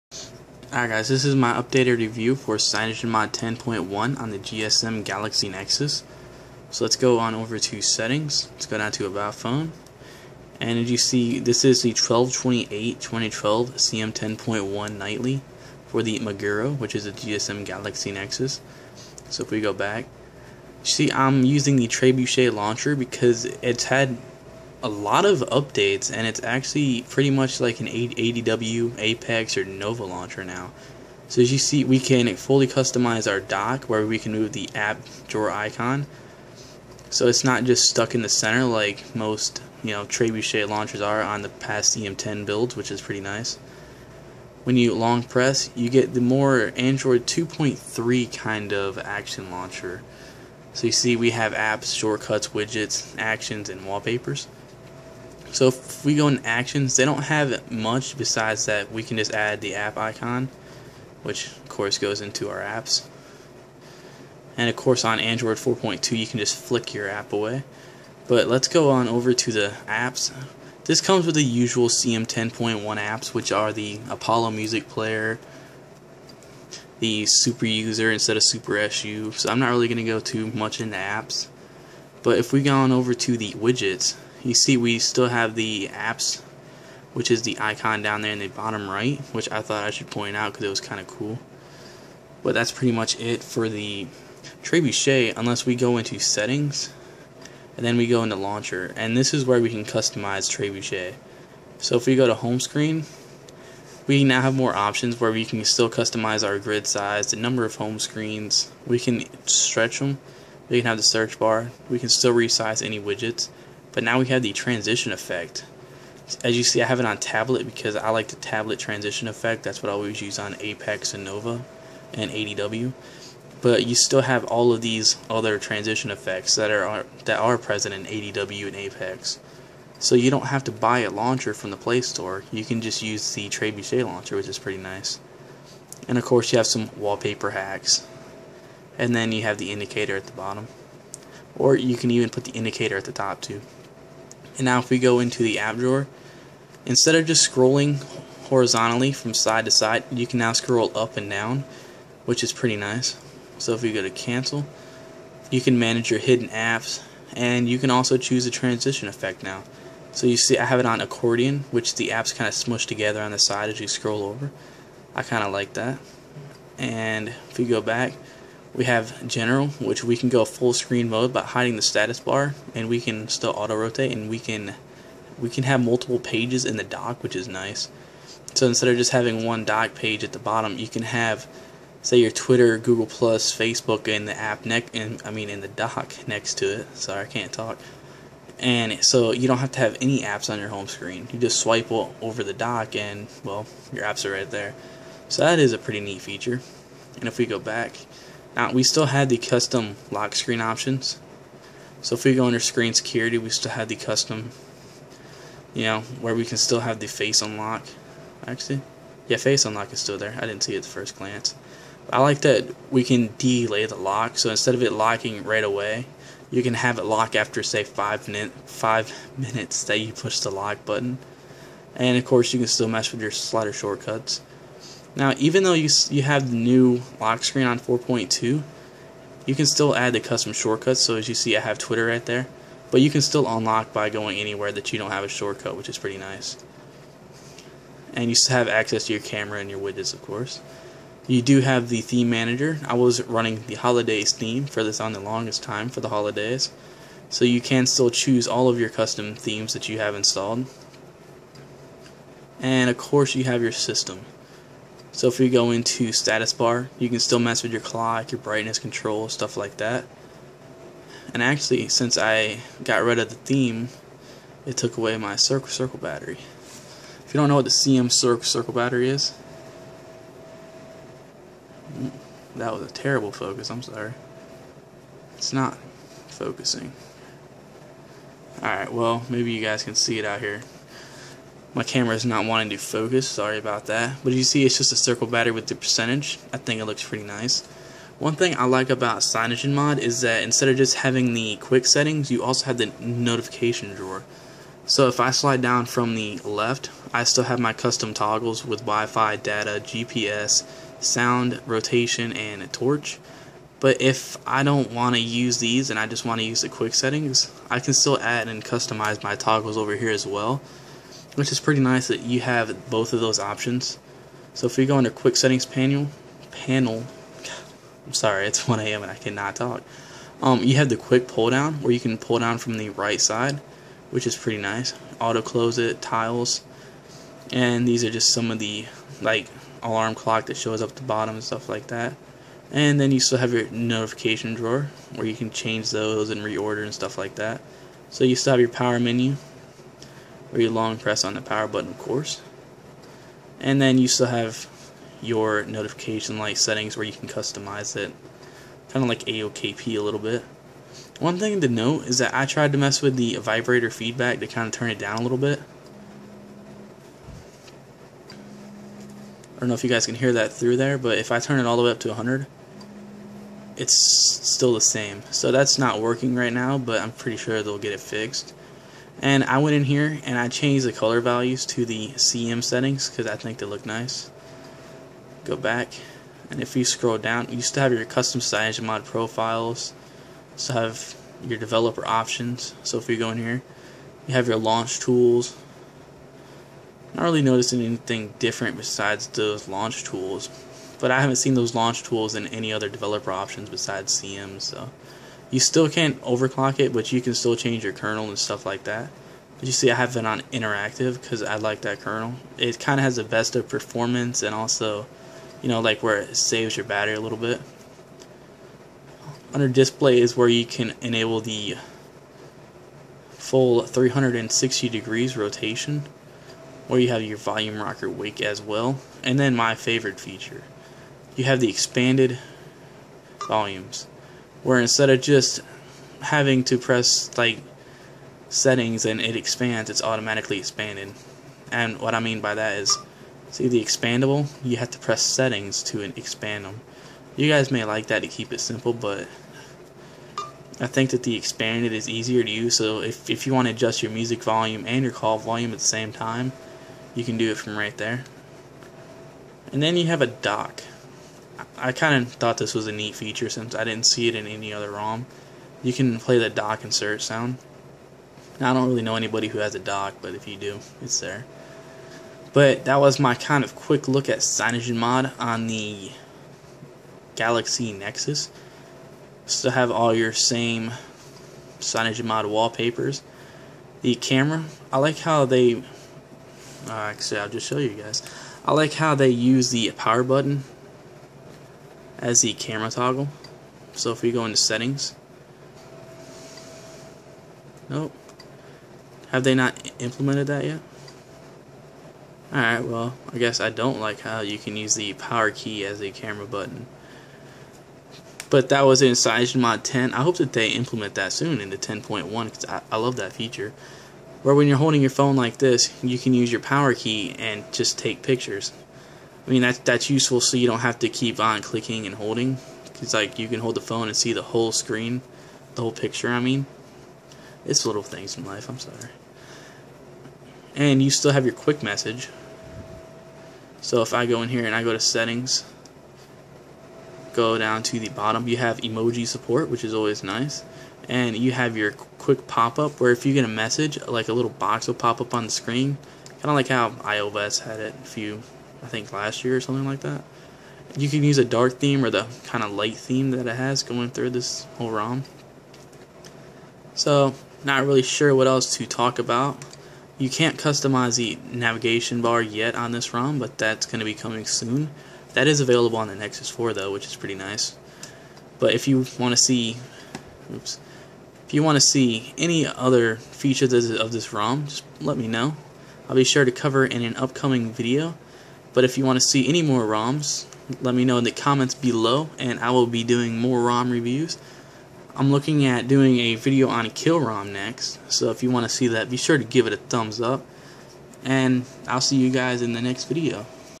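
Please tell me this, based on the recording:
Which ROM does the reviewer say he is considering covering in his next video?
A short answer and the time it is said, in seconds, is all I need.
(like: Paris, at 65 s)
Kill ROM, at 576 s.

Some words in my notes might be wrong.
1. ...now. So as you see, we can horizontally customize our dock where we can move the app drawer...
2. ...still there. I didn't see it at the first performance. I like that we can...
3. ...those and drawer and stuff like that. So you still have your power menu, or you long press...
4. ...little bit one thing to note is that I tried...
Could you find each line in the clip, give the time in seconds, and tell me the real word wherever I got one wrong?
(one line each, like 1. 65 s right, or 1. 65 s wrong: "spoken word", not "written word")
1. 30 s wrong: "fully", not "horizontally"
2. 209 s wrong: "glance", not "performance"
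3. 335 s wrong: "reorder", not "drawer"
4. 350 s right.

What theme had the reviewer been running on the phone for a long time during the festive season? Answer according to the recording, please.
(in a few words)
Holidays theme.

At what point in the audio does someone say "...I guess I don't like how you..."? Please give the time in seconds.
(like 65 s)
493 s.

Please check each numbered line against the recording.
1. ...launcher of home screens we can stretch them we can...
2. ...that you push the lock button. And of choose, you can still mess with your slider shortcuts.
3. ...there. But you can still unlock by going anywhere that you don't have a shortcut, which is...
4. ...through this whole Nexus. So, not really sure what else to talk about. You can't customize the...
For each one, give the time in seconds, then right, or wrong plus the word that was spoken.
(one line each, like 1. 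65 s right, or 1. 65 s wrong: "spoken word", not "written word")
1. 107 s wrong: "number", not "launcher"
2. 219 s wrong: "course", not "choose"
3. 232 s right
4. 544 s wrong: "ROM", not "Nexus".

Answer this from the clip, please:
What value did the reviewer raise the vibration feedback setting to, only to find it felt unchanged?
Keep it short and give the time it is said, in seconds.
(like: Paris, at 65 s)
100, at 362 s.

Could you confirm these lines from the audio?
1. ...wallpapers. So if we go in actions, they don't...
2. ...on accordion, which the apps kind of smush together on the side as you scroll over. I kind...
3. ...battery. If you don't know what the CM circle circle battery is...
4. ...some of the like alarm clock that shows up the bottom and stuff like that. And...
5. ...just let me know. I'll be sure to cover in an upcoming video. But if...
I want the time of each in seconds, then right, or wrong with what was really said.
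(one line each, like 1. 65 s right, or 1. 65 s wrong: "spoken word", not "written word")
1. 53 s right
2. 160 s right
3. 265 s right
4. 328 s right
5. 564 s right.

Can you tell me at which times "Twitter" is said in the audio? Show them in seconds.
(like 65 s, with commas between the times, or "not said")
182 s, 231 s.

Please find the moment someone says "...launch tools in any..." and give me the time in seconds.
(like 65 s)
391 s.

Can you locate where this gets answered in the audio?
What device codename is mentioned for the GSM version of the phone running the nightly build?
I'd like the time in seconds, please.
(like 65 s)
16 s.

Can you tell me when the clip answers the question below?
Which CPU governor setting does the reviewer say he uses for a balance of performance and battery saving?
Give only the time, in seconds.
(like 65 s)
400 s.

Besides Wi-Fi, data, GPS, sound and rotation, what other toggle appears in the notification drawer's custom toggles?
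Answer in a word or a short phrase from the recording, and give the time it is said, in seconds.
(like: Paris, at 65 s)
Torch, at 302 s.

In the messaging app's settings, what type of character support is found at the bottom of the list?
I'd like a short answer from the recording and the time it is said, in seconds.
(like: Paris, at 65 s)
Emoji, at 528 s.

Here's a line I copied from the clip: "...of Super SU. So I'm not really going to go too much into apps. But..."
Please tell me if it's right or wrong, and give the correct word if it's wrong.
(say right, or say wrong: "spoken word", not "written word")
right.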